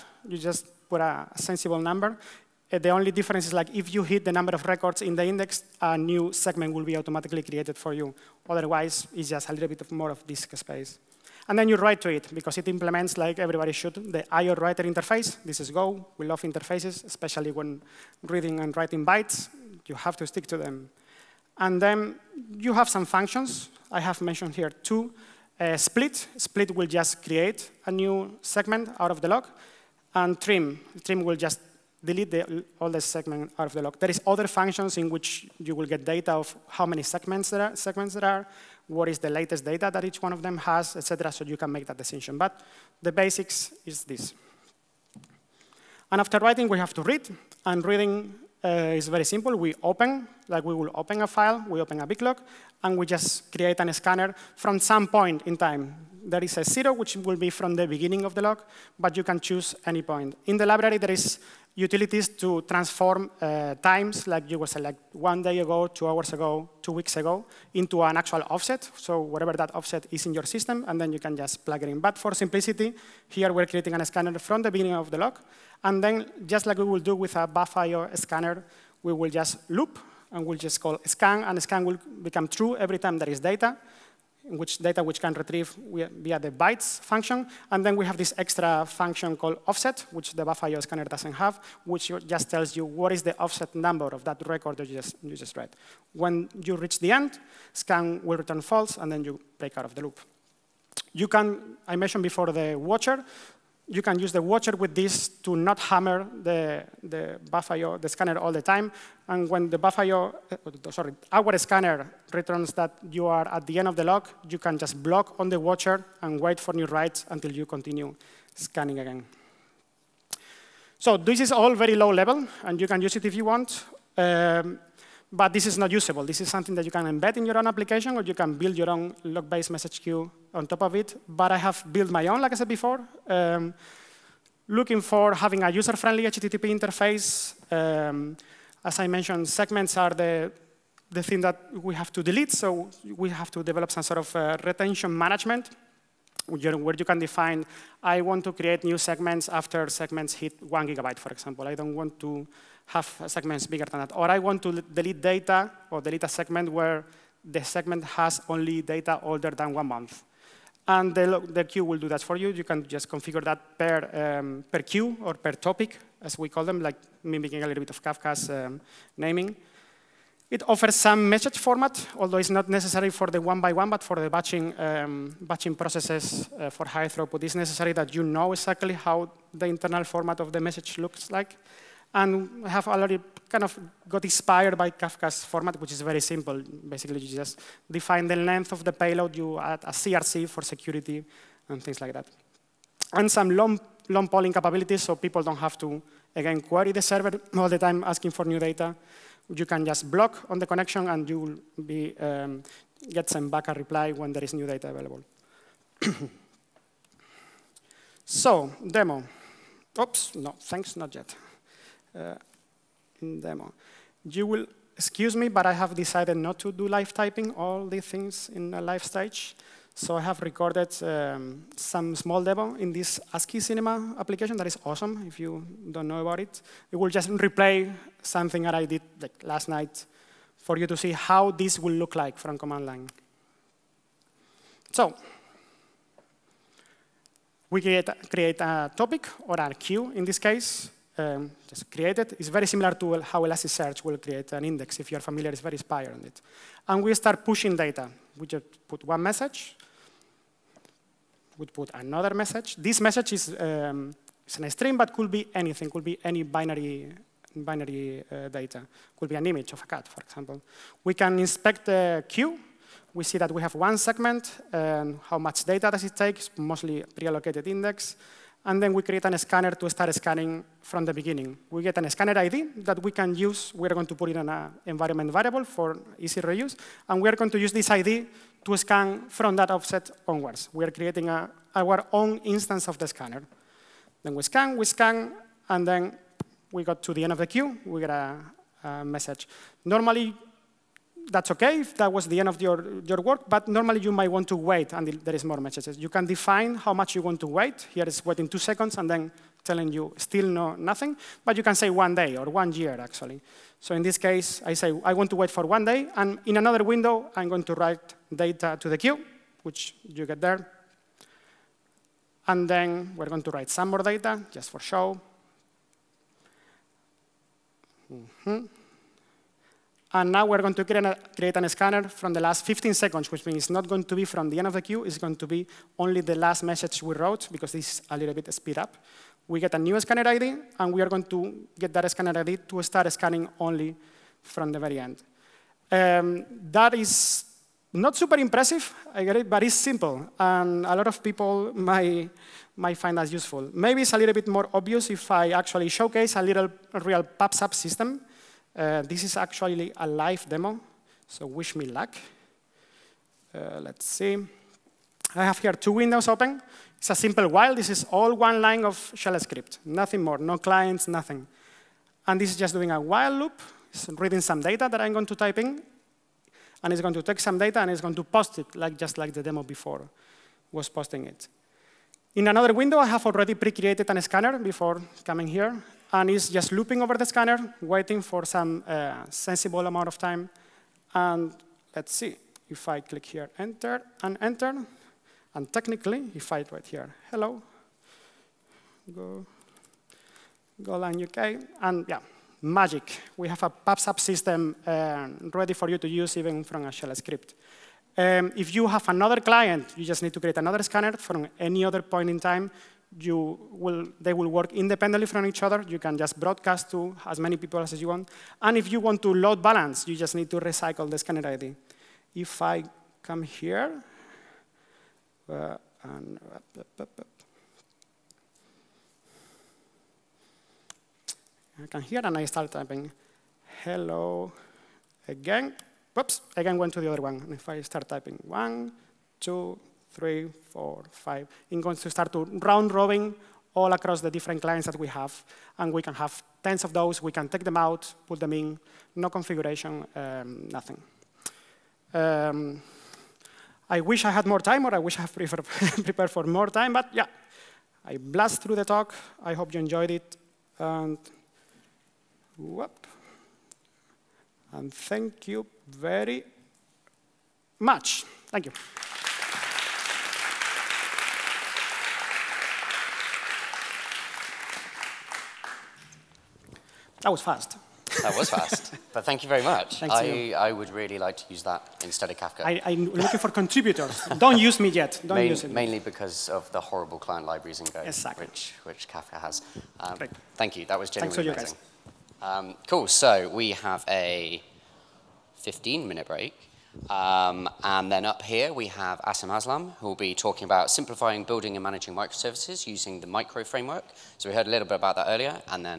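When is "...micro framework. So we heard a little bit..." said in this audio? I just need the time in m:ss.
8:13.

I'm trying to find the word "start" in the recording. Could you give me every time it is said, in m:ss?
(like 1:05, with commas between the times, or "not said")
4:07, 4:29, 5:32, 7:02, 7:07, 7:12.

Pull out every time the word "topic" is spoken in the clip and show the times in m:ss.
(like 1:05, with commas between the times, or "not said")
2:45, 3:58.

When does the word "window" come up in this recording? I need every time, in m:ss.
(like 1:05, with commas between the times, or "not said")
5:06, 5:55, 6:12.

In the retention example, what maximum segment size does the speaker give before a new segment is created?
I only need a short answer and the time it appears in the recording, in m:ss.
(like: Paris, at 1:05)
1 gigabyte, at 2:30.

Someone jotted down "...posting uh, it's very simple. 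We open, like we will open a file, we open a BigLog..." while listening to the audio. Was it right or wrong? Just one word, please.
wrong.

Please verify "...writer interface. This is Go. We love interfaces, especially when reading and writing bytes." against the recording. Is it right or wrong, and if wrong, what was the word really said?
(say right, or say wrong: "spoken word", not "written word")
right.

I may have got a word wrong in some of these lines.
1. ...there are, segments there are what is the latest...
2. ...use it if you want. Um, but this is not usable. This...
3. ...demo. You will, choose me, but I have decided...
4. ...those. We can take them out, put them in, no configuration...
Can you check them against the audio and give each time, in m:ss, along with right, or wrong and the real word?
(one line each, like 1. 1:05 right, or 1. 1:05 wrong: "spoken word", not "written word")
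1. 0:37 right
2. 2:03 right
3. 3:33 wrong: "excuse", not "choose"
4. 7:16 right.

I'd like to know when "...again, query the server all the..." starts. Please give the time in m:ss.
3:16.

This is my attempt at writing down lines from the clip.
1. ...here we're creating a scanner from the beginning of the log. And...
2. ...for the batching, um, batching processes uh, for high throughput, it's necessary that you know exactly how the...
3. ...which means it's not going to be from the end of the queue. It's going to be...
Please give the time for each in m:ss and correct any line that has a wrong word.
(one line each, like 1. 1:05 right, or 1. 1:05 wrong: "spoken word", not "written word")
1. 1:13 right
2. 2:54 right
3. 5:23 right.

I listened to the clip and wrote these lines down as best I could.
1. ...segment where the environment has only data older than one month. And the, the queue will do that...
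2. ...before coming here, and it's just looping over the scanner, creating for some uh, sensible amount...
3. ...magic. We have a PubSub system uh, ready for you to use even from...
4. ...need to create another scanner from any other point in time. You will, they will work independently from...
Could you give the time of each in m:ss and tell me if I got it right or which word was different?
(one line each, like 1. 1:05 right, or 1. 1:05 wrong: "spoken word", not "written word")
1. 2:36 wrong: "segment", not "environment"
2. 6:14 wrong: "waiting", not "creating"
3. 6:32 right
4. 6:40 right.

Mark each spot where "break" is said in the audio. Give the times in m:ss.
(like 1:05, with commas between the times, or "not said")
1:39, 8:06.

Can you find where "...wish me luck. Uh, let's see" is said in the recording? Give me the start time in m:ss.
5:51.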